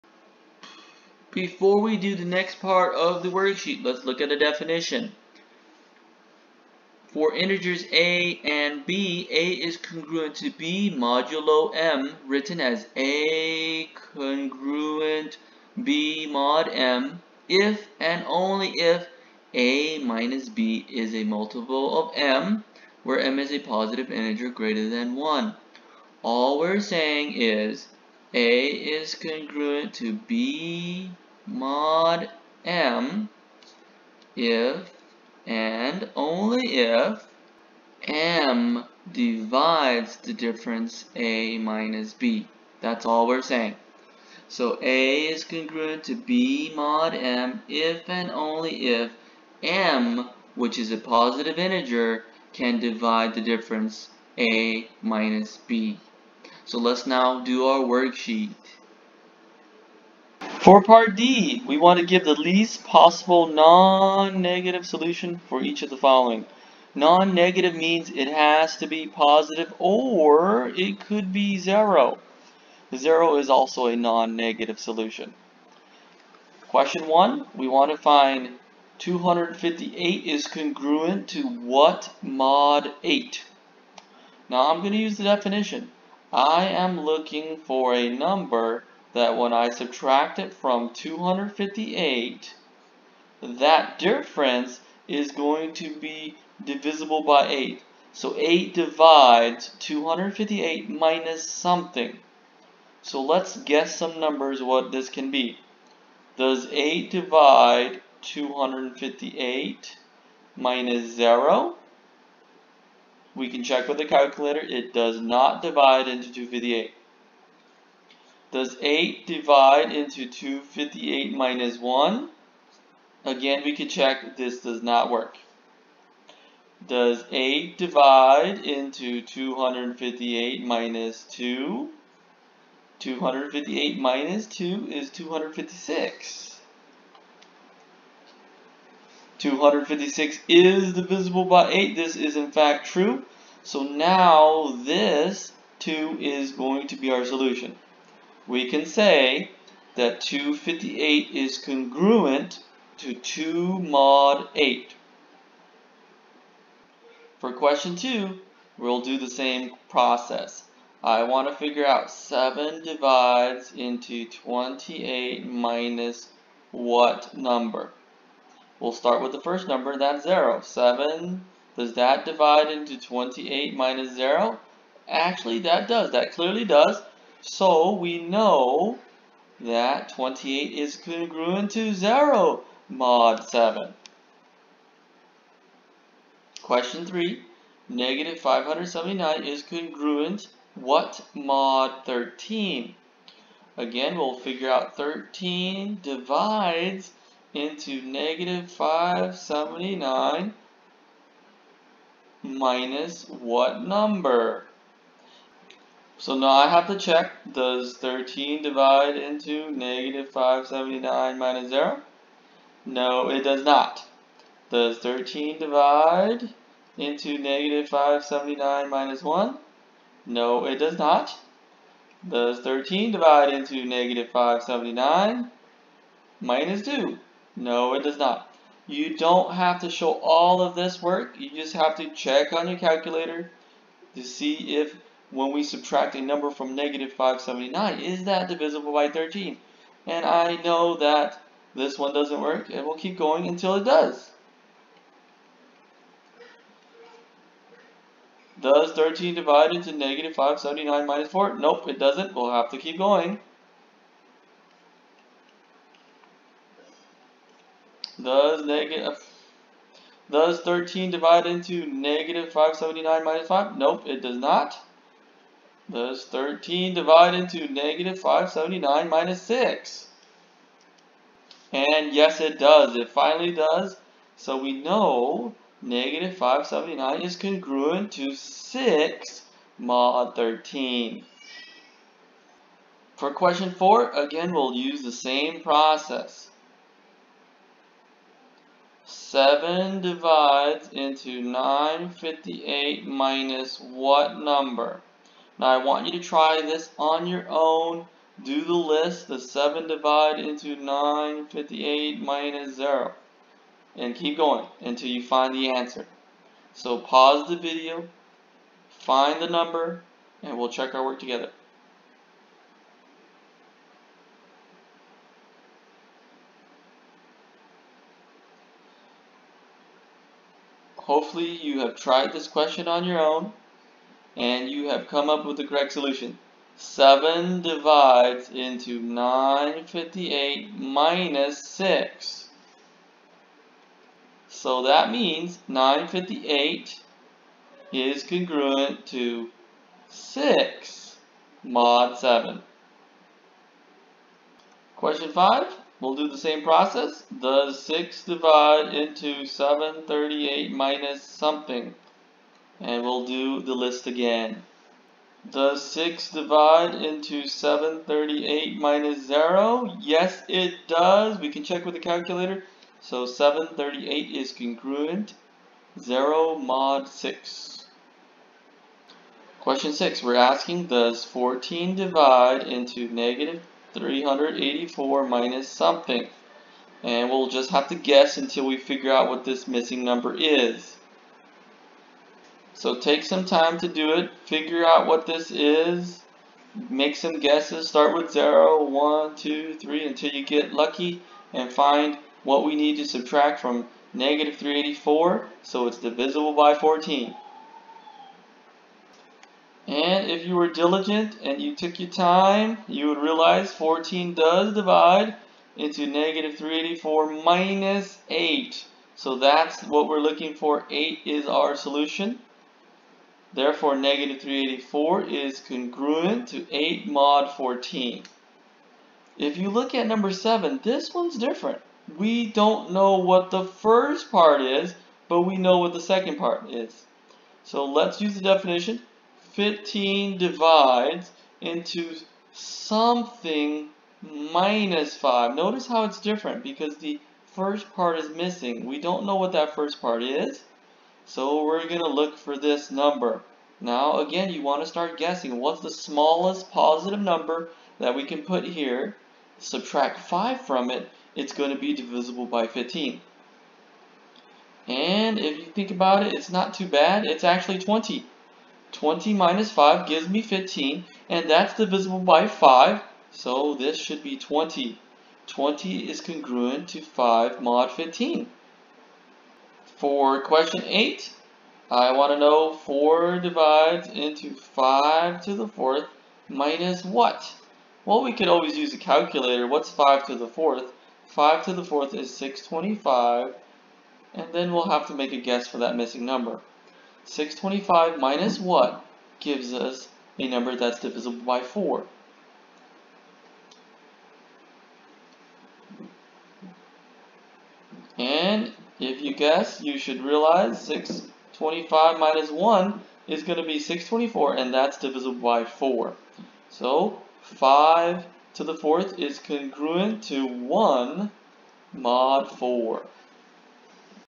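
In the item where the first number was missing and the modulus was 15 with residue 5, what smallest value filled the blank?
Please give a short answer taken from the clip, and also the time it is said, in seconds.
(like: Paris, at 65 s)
20, at 457 s.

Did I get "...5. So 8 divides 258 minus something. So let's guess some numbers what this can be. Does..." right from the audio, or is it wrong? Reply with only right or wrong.
wrong.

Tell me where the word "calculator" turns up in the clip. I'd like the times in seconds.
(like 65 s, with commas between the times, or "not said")
114 s, 232 s, 361 s, 478 s.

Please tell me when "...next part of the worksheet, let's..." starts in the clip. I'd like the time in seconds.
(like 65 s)
2 s.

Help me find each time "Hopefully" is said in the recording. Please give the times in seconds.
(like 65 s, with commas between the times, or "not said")
321 s.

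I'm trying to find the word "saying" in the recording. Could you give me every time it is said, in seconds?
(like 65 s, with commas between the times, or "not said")
26 s, 43 s.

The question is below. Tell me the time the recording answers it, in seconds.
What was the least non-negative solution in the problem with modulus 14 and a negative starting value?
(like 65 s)
410 s.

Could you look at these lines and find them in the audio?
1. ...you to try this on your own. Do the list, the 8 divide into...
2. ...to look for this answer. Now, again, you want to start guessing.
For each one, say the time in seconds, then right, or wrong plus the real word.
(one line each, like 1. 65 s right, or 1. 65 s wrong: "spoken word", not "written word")
1. 296 s wrong: "7", not "8"
2. 441 s wrong: "number", not "answer".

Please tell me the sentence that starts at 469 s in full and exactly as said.
For question 8, I want to know 4 divides into 5 to the 4th minus what?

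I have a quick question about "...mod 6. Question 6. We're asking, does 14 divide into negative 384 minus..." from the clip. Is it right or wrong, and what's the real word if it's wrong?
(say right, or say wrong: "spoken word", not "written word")
right.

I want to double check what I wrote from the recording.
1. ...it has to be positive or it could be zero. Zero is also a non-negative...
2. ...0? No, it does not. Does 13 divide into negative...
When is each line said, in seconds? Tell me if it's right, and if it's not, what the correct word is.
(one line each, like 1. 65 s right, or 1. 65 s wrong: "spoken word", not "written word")
1. 68 s right
2. 211 s right.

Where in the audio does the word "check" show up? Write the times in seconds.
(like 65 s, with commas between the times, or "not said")
113 s, 123 s, 206 s, 232 s, 310 s, 361 s.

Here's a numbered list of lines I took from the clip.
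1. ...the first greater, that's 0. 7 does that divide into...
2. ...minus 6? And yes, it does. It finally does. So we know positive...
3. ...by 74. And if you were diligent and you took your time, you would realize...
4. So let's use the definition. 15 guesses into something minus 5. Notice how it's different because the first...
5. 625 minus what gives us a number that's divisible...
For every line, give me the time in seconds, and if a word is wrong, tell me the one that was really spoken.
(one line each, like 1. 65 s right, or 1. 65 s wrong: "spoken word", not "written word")
1. 169 s wrong: "number", not "greater"
2. 269 s wrong: "negative", not "positive"
3. 396 s wrong: "14", not "74"
4. 427 s wrong: "divides", not "guesses"
5. 487 s right.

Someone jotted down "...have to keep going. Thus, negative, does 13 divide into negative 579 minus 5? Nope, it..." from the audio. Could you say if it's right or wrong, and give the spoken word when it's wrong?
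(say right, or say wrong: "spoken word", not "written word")
right.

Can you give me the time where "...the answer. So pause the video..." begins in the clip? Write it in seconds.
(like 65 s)
305 s.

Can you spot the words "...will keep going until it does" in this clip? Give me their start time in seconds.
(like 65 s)
242 s.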